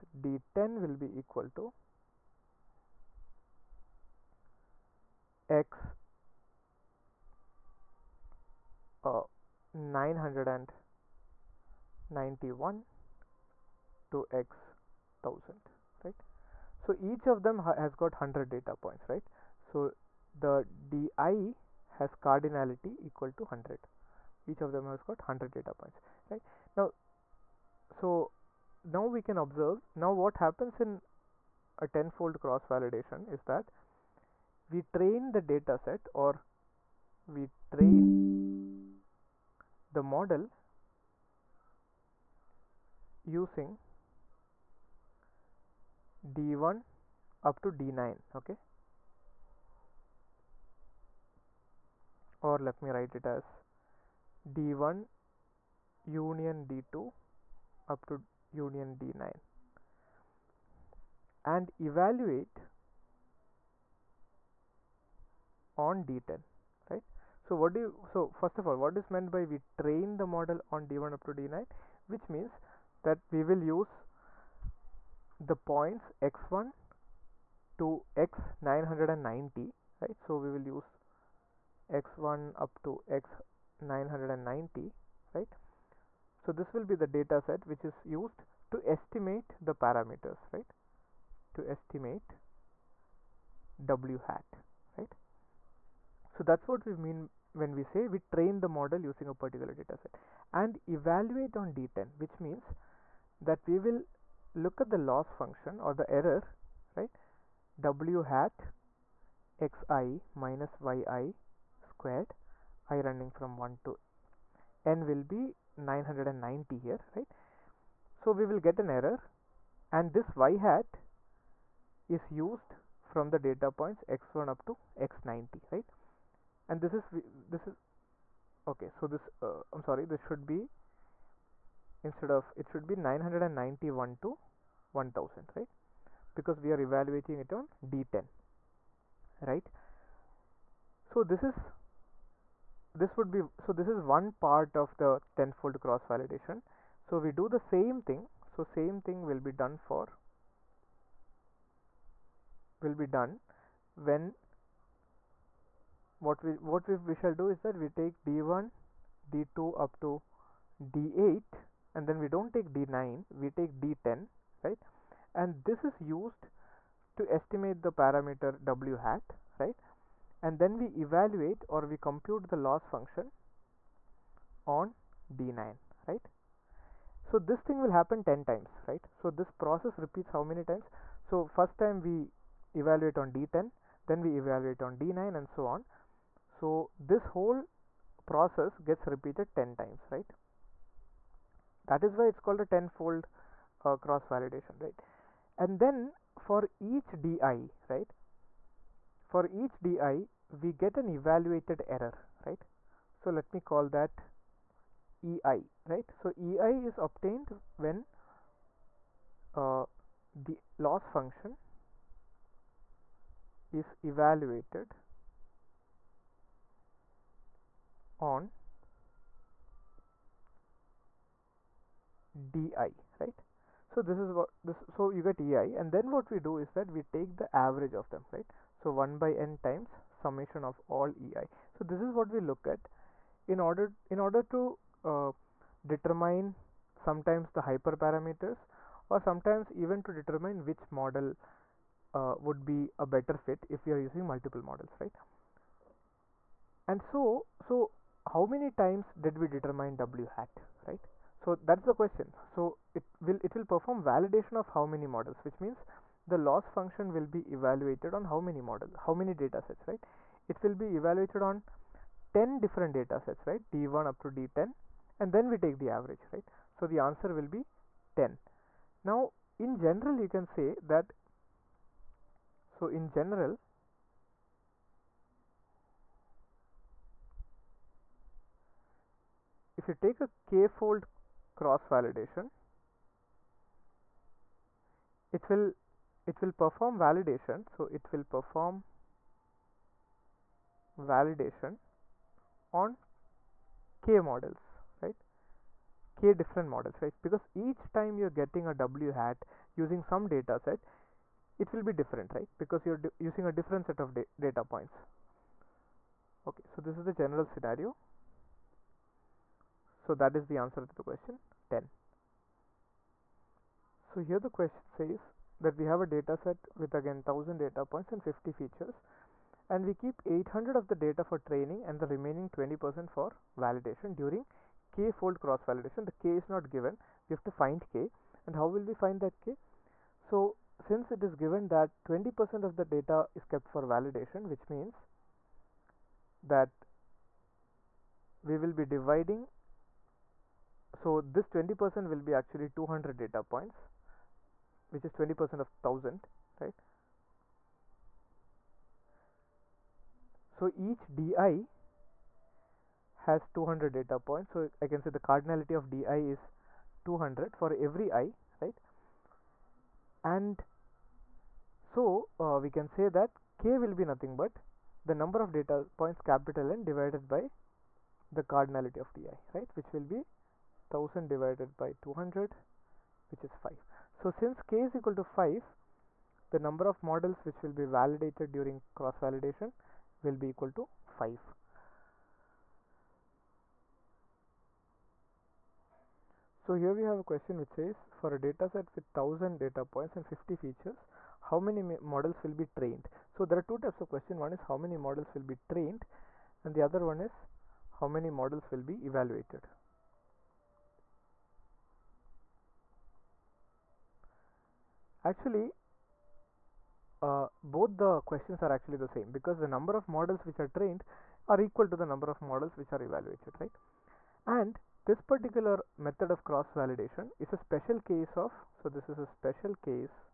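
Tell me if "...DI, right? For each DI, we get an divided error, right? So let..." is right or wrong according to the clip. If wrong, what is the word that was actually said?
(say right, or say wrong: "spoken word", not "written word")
wrong: "evaluated", not "divided".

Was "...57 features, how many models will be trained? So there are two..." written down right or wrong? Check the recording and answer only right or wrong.
wrong.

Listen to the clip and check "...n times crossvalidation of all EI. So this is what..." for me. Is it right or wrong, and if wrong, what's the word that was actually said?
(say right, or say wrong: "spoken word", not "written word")
wrong: "summation", not "crossvalidation".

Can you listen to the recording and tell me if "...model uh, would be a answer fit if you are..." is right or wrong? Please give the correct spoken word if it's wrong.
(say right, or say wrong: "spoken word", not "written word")
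wrong: "better", not "answer".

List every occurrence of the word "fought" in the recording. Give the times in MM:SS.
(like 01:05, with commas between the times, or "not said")
not said.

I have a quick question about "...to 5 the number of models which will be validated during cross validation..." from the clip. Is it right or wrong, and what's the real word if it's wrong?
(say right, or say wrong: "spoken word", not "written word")
right.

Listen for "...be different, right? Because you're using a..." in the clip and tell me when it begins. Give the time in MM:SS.
05:01.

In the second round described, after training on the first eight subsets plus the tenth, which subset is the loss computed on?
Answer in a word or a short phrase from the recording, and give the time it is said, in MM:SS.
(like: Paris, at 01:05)
D9, at 02:52.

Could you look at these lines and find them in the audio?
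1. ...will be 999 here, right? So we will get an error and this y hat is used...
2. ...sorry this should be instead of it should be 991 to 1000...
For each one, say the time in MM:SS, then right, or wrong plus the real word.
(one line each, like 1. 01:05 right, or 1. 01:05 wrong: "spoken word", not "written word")
1. 01:55 wrong: "990", not "999"
2. 02:09 right.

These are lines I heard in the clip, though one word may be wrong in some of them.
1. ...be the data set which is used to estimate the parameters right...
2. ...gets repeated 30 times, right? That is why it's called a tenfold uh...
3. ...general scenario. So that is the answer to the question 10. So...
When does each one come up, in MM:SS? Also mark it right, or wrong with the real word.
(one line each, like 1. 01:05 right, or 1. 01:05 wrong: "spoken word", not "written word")
1. 01:26 right
2. 03:08 wrong: "10", not "30"
3. 05:07 right.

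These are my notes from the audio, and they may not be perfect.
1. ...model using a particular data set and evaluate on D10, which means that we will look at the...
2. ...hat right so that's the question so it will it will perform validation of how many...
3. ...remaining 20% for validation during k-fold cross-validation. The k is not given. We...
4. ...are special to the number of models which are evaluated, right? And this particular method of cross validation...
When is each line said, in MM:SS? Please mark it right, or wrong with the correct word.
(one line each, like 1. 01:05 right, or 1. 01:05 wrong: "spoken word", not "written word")
1. 01:38 right
2. 04:10 right
3. 05:22 right
4. 06:51 wrong: "equal", not "special".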